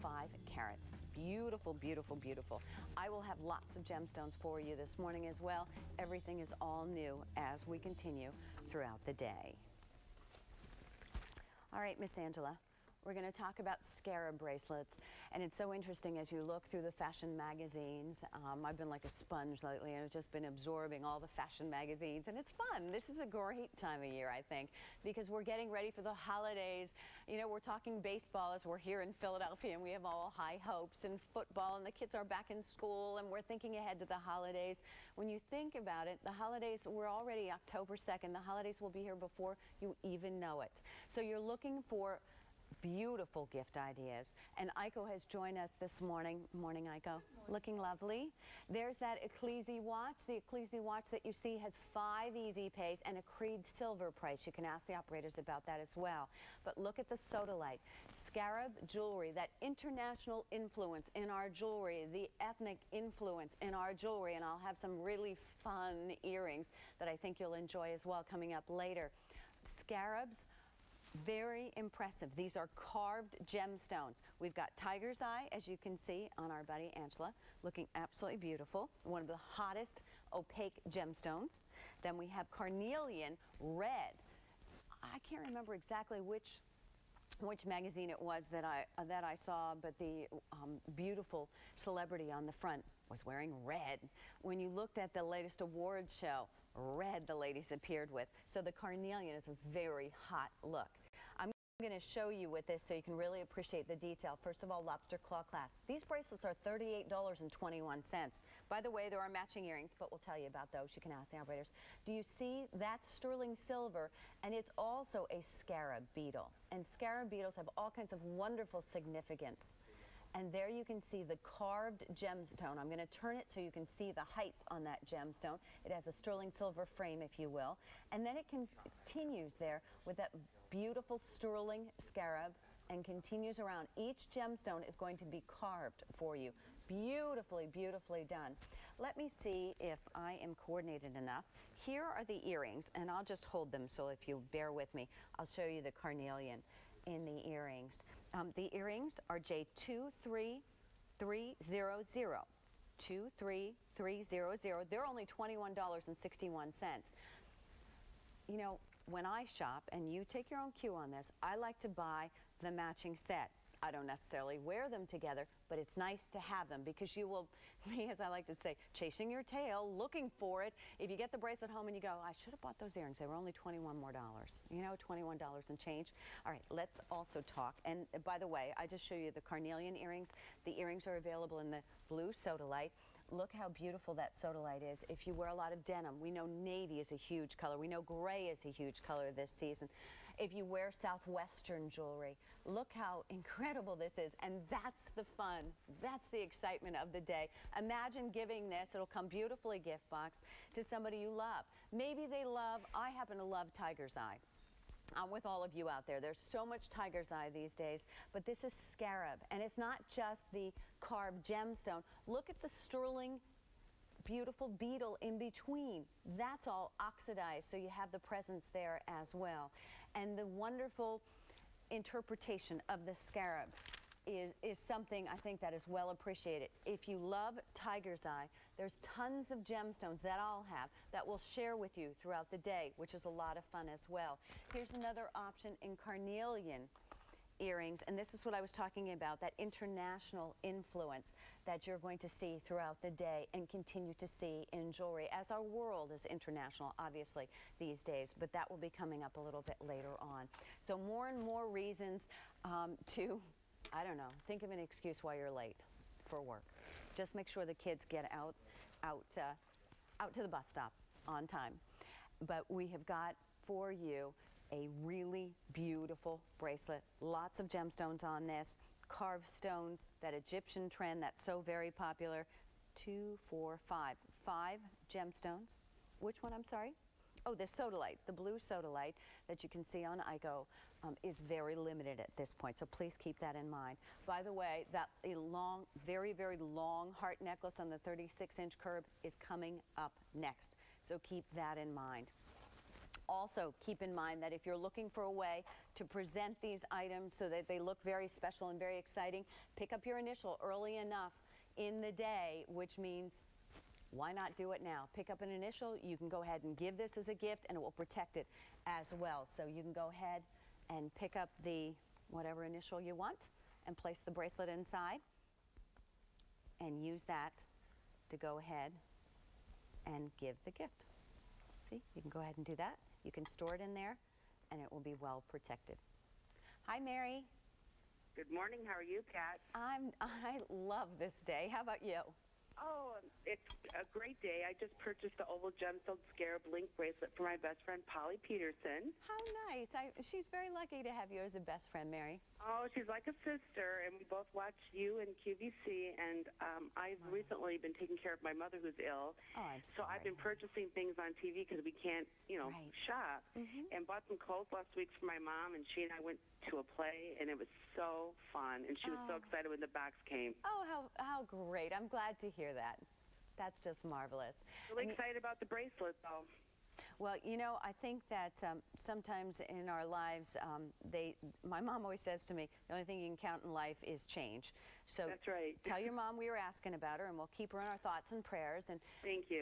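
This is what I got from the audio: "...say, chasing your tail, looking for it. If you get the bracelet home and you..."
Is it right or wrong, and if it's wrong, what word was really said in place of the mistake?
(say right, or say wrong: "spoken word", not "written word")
right.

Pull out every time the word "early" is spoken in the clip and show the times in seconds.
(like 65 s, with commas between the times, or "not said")
300 s.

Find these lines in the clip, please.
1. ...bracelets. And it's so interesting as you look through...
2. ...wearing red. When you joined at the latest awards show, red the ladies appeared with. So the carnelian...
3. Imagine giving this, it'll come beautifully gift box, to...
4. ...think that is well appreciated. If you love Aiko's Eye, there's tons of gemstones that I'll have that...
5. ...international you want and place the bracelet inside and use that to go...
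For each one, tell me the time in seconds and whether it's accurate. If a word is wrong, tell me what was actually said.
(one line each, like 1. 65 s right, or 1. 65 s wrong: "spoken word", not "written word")
1. 14 s right
2. 93 s wrong: "looked", not "joined"
3. 197 s right
4. 225 s wrong: "Tiger", not "Aiko"
5. 312 s wrong: "initial", not "international".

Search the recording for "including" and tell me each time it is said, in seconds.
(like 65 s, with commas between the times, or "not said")
not said.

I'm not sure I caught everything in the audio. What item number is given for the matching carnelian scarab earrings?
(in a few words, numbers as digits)
J23300.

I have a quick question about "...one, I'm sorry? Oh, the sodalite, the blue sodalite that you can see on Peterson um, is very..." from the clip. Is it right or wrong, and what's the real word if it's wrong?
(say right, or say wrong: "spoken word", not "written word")
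wrong: "Aiko", not "Peterson".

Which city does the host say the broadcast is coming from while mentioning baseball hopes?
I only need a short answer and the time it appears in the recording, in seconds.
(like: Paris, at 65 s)
Philadelphia, at 29 s.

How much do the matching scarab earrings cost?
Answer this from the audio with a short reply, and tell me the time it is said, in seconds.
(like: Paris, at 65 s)
$21.61, at 155 s.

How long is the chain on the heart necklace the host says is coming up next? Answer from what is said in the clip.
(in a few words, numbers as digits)
36 inches.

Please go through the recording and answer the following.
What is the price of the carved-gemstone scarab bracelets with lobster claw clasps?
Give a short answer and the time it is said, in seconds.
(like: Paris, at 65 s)
$38.21, at 106 s.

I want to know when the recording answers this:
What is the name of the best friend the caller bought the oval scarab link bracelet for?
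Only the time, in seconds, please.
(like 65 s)
338 s.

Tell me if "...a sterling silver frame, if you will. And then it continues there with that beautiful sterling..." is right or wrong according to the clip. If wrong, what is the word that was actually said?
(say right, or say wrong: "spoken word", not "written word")
right.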